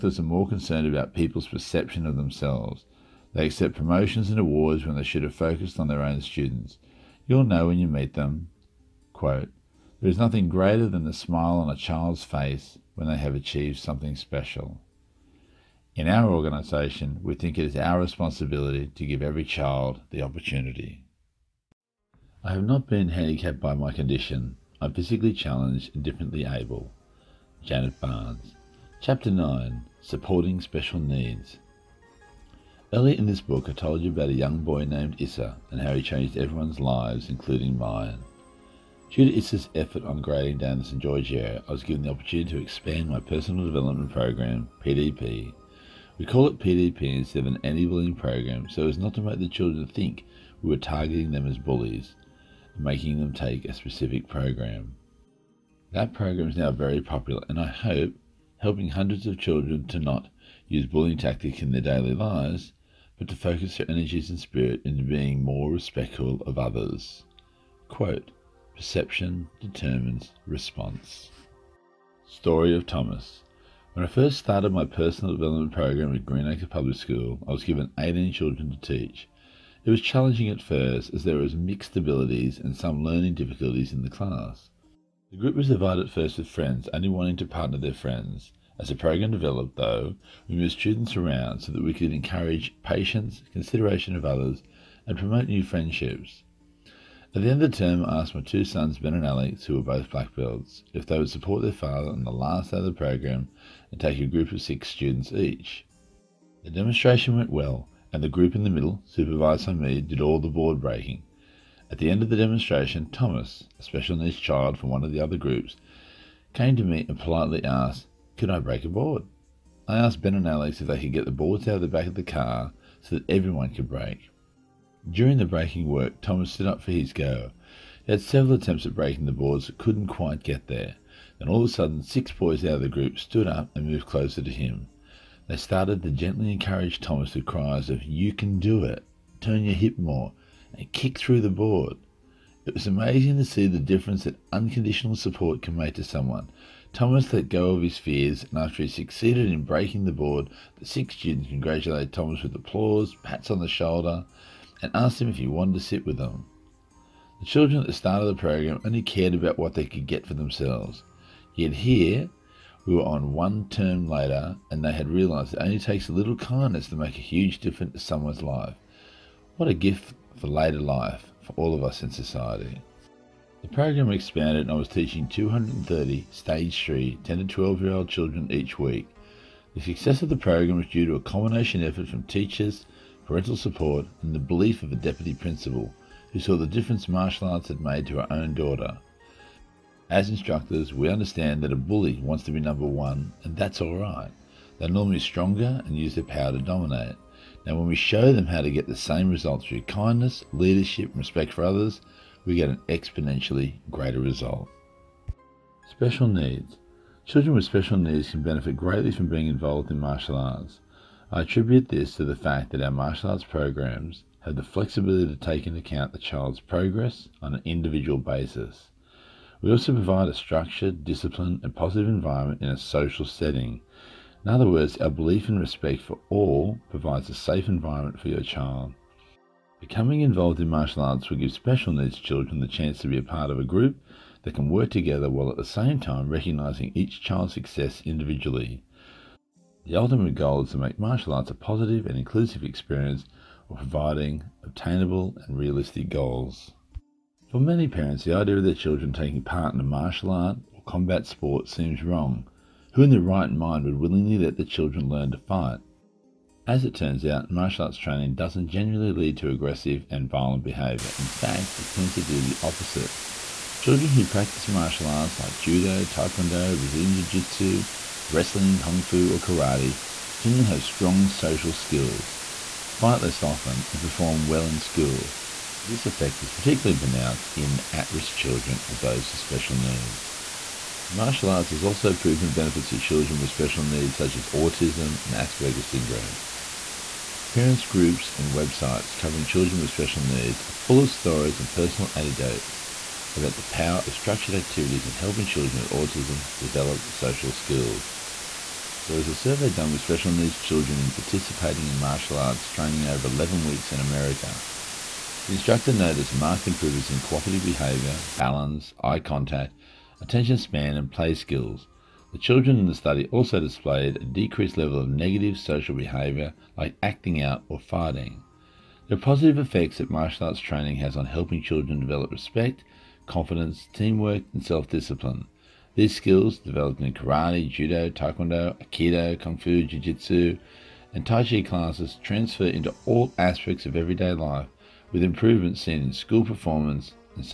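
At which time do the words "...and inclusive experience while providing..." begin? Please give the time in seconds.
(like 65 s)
242 s.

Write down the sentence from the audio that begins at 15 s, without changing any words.
In our organisation, we think it is our responsibility to give every child the opportunity.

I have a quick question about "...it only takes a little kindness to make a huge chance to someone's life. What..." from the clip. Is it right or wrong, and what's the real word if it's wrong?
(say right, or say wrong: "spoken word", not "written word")
wrong: "difference", not "chance".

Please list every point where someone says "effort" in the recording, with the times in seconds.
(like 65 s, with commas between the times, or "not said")
39 s, 181 s.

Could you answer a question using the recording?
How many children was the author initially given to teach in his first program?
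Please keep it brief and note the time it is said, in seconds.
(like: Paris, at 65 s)
18, at 77 s.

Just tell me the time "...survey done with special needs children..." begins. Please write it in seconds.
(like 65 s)
299 s.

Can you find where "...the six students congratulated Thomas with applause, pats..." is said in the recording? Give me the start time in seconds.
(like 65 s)
150 s.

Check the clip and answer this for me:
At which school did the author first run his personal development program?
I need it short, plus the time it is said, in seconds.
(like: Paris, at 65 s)
Greenacre Public School, at 76 s.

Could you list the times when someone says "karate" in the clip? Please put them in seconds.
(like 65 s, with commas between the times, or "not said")
269 s, 327 s.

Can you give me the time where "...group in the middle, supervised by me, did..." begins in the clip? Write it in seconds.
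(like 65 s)
108 s.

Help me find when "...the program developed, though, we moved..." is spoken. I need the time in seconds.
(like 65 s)
88 s.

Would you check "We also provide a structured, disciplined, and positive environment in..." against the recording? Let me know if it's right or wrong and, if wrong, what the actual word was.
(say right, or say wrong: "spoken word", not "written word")
right.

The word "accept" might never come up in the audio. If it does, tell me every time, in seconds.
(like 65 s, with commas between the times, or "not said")
3 s.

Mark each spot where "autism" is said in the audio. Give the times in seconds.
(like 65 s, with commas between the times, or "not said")
284 s, 295 s.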